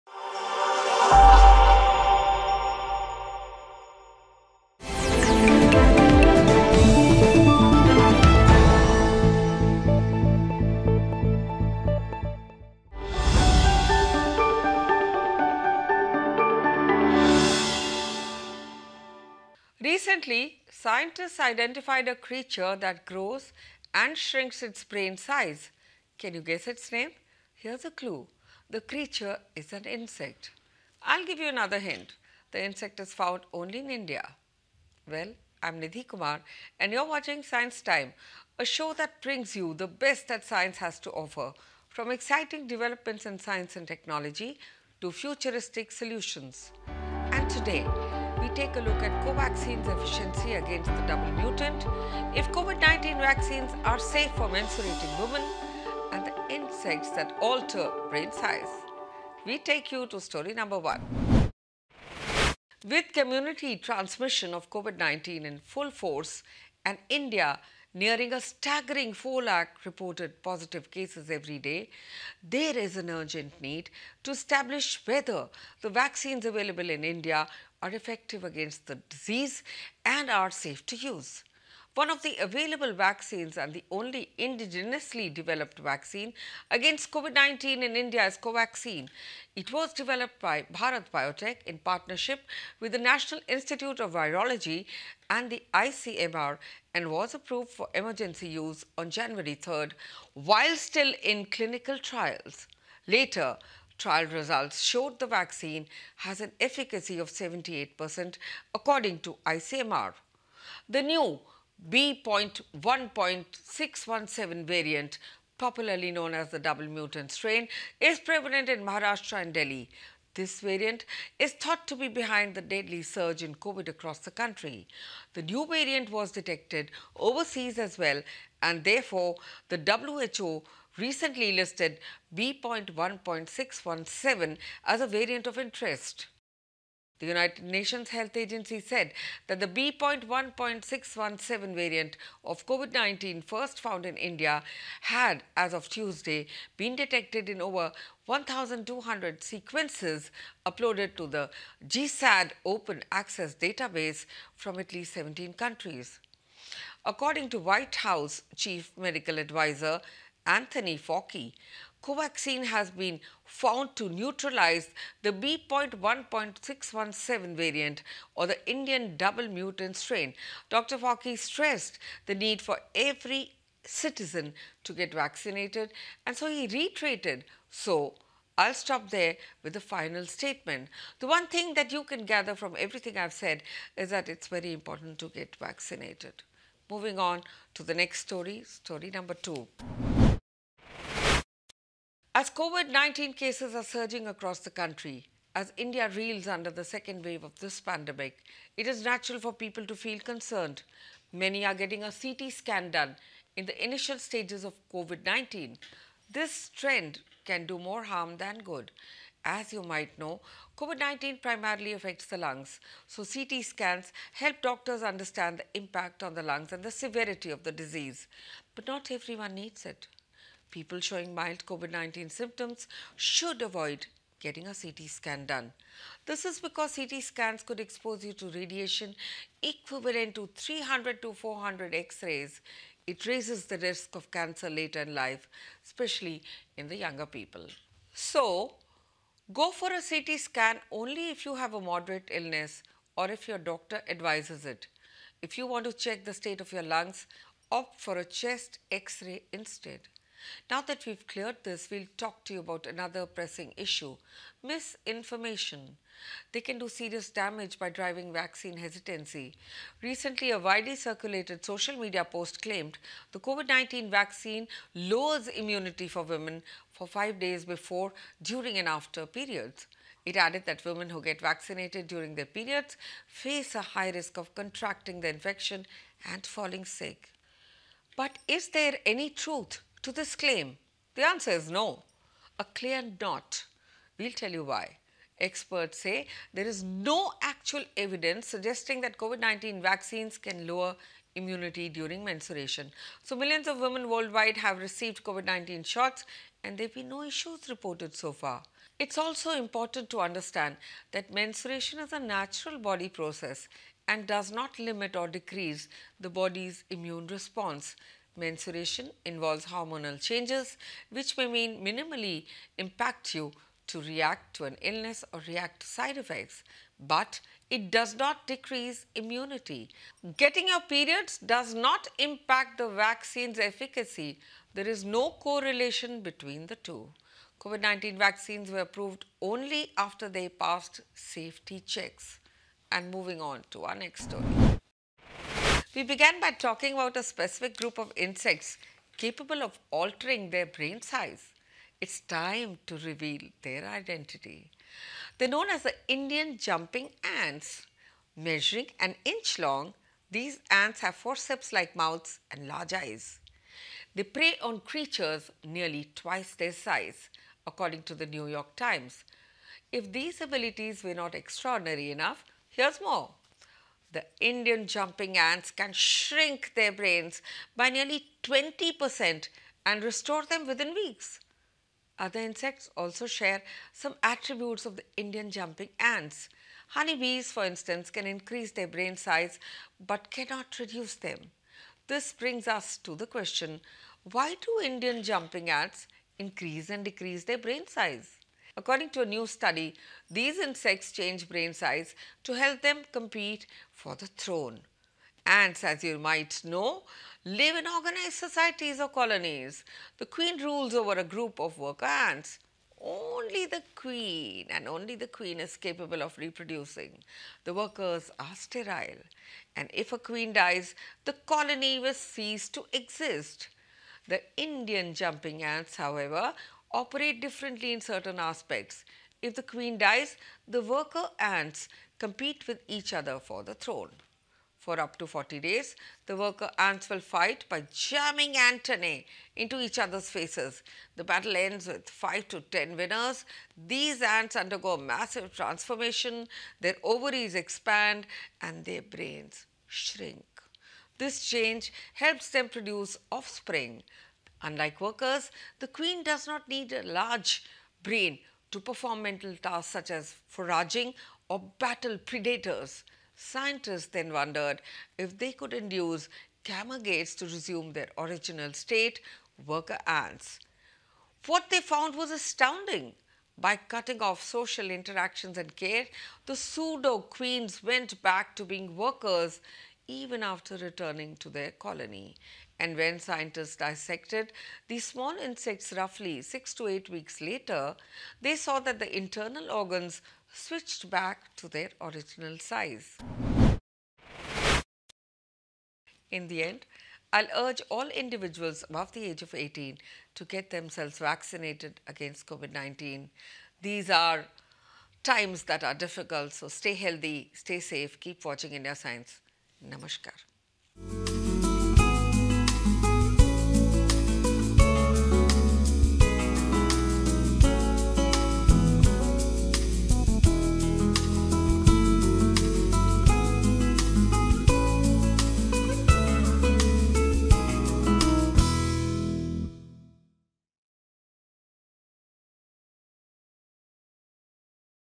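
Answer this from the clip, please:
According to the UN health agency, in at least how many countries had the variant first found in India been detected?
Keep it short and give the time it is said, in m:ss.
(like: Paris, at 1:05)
17, at 2:35.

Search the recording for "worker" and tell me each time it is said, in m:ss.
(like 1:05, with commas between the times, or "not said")
6:41, 6:47, 7:00, 7:06, 7:25, 7:39, 7:48.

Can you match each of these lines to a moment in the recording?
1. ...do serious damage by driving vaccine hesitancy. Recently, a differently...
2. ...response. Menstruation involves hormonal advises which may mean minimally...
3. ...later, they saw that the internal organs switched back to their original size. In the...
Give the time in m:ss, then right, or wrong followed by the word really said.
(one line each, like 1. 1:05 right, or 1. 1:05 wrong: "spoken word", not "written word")
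1. 4:16 wrong: "widely", not "differently"
2. 5:07 wrong: "changes", not "advises"
3. 7:57 right.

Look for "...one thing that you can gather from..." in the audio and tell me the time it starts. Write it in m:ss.
3:01.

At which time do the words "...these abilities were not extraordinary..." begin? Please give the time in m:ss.
6:00.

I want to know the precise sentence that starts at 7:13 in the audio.
These ants undergo massive transformation, their ovaries expand and their brains shrink.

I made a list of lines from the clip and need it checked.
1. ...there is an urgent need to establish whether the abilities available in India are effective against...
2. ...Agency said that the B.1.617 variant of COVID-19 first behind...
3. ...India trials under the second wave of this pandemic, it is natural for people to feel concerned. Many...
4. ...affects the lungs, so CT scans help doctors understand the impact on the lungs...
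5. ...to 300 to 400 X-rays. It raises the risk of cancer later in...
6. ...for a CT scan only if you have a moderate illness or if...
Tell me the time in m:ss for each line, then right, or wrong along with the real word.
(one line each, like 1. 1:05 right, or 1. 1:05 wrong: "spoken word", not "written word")
1. 1:12 wrong: "vaccines", not "abilities"
2. 2:18 wrong: "found", not "behind"
3. 3:15 wrong: "reels", not "trials"
4. 3:31 right
5. 3:50 right
6. 3:59 right.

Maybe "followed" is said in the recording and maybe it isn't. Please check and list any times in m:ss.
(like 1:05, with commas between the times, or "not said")
not said.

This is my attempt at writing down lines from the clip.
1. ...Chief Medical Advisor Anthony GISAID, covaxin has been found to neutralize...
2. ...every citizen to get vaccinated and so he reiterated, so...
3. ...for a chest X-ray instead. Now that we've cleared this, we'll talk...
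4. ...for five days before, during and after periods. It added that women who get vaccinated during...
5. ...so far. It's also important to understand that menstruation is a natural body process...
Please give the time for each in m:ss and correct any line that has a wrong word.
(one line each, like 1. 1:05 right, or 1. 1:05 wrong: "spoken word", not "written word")
1. 2:38 wrong: "Fauci", not "GISAID"
2. 2:52 right
3. 4:07 right
4. 4:26 right
5. 4:58 right.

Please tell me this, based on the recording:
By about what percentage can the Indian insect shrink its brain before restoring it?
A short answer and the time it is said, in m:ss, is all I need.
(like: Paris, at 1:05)
20%, at 6:08.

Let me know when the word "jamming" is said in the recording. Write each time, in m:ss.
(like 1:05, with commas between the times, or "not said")
7:07.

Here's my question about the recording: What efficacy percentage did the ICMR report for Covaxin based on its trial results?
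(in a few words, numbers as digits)
78%.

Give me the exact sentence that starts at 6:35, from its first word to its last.
Ants, as you might know, live in organized societies or colonies.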